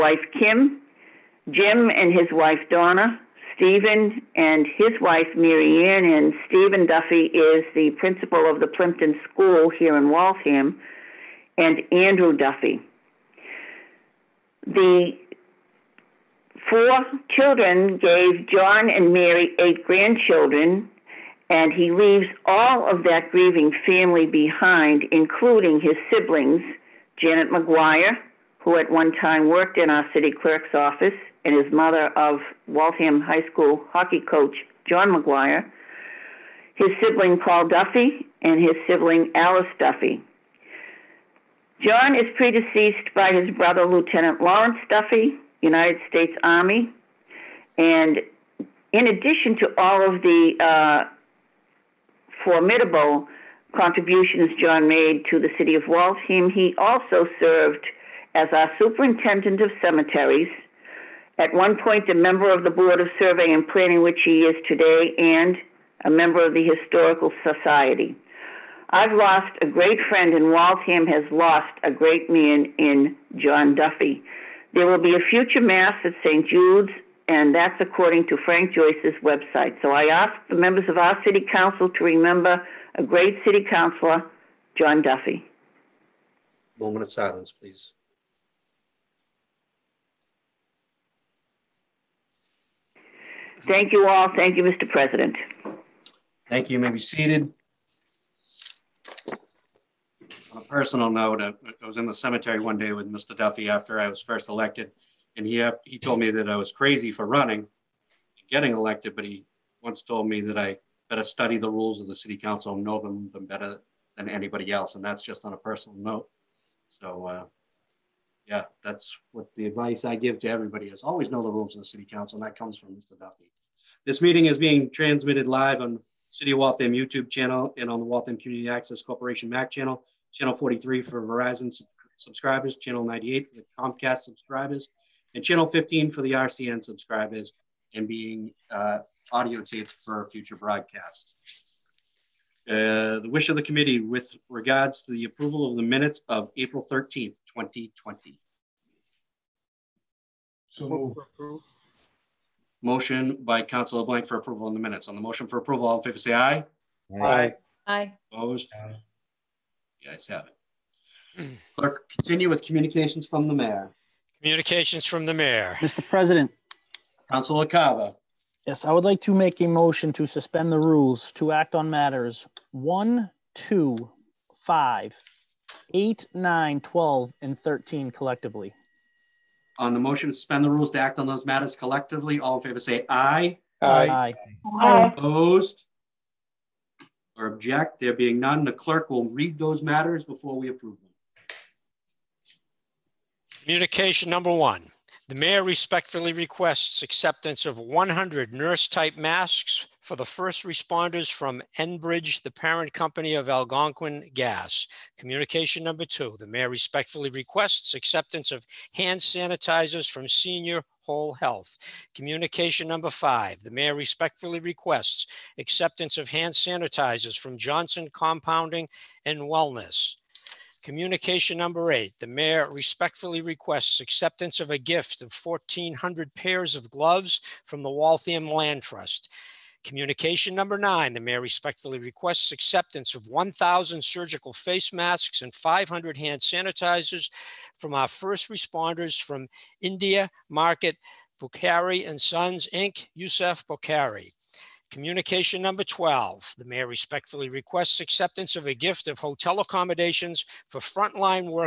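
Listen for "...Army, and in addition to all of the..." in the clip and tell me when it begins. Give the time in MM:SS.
00:46.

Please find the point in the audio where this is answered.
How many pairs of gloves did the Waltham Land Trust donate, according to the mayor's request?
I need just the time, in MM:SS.
03:45.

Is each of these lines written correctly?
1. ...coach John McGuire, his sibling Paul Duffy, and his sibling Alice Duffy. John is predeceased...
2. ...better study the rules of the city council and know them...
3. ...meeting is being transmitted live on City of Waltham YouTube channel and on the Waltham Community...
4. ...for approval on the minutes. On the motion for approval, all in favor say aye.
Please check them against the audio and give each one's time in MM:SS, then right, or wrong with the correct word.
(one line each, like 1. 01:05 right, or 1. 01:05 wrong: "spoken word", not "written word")
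1. 00:34 right
2. 01:51 right
3. 02:04 right
4. 02:34 right.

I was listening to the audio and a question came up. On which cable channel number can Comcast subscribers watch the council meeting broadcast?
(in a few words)
98.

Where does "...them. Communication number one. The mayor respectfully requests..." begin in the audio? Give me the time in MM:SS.
03:10.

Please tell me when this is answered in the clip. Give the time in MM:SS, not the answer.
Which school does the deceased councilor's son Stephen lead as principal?
00:08.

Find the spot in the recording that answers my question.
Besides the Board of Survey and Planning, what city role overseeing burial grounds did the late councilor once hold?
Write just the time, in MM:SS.
00:58.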